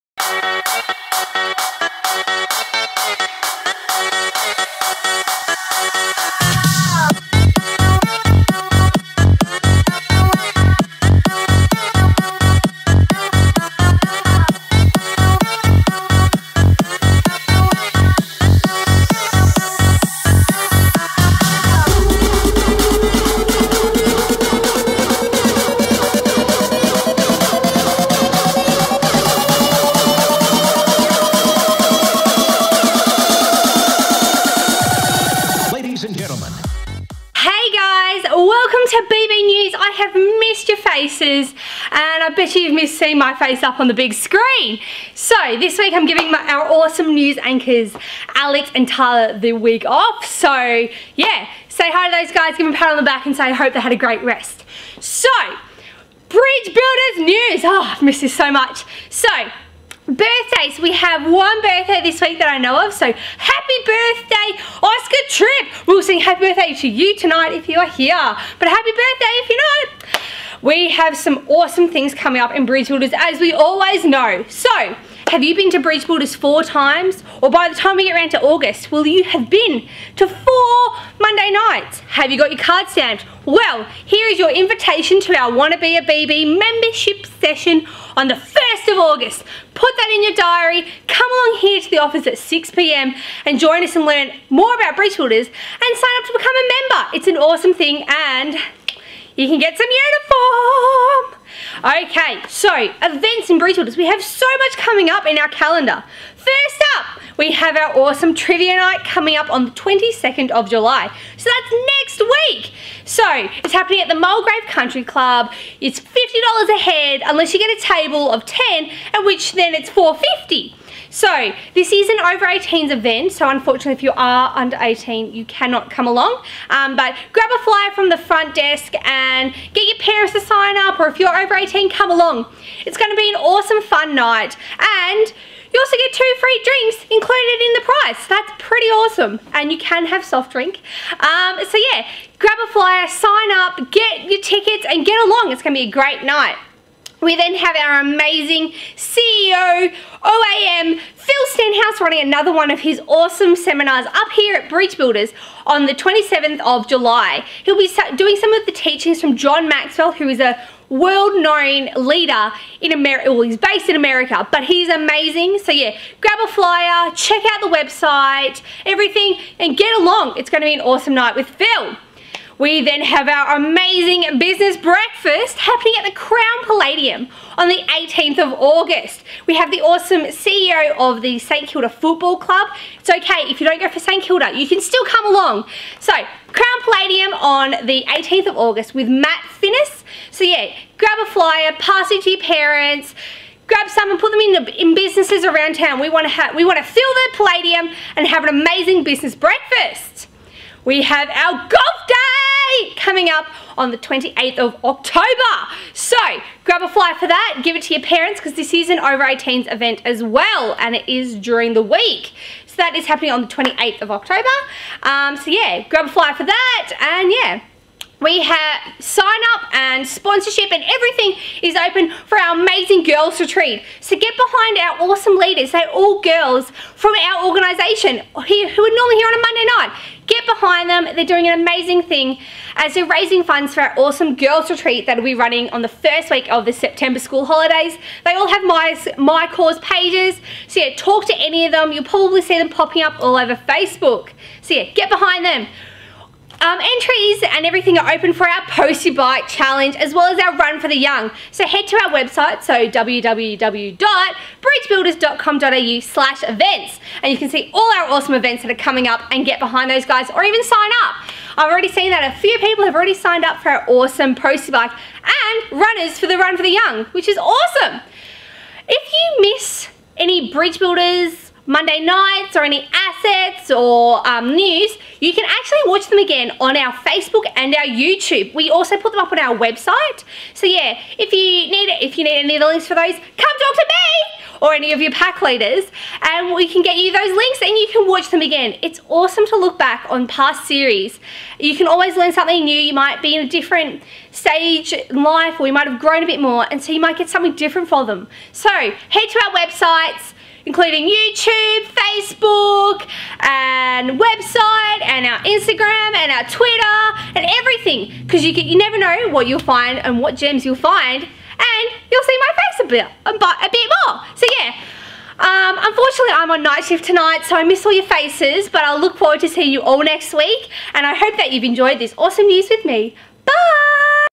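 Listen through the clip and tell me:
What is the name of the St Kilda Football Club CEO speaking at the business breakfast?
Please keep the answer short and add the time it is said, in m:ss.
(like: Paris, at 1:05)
Matt Finnis, at 3:09.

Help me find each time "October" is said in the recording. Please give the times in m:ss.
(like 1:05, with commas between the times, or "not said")
3:24, 3:34.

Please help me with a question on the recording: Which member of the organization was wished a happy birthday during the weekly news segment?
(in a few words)
Oscar Tripp.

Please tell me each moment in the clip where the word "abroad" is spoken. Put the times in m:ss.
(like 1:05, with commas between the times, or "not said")
not said.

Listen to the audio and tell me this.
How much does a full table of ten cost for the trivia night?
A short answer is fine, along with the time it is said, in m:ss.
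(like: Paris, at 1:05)
$450, at 1:59.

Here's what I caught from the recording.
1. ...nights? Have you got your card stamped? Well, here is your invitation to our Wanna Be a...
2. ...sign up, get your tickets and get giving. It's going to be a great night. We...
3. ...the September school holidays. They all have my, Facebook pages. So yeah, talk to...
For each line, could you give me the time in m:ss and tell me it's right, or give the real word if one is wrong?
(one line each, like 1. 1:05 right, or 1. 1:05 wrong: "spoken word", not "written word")
1. 1:21 right
2. 2:23 wrong: "along", not "giving"
3. 3:56 wrong: "MyCause", not "Facebook".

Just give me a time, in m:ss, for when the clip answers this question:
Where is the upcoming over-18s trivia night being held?
1:54.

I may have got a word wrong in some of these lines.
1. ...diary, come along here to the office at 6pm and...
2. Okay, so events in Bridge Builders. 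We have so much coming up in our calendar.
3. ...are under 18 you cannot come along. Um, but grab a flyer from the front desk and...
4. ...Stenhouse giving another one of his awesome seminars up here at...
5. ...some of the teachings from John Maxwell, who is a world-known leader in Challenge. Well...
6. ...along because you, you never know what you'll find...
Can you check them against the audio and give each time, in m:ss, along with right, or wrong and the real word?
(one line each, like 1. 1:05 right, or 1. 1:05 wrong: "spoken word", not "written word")
1. 1:30 right
2. 1:41 right
3. 2:04 right
4. 2:31 wrong: "running", not "giving"
5. 2:38 wrong: "America", not "Challenge"
6. 5:07 wrong: "everything", not "along".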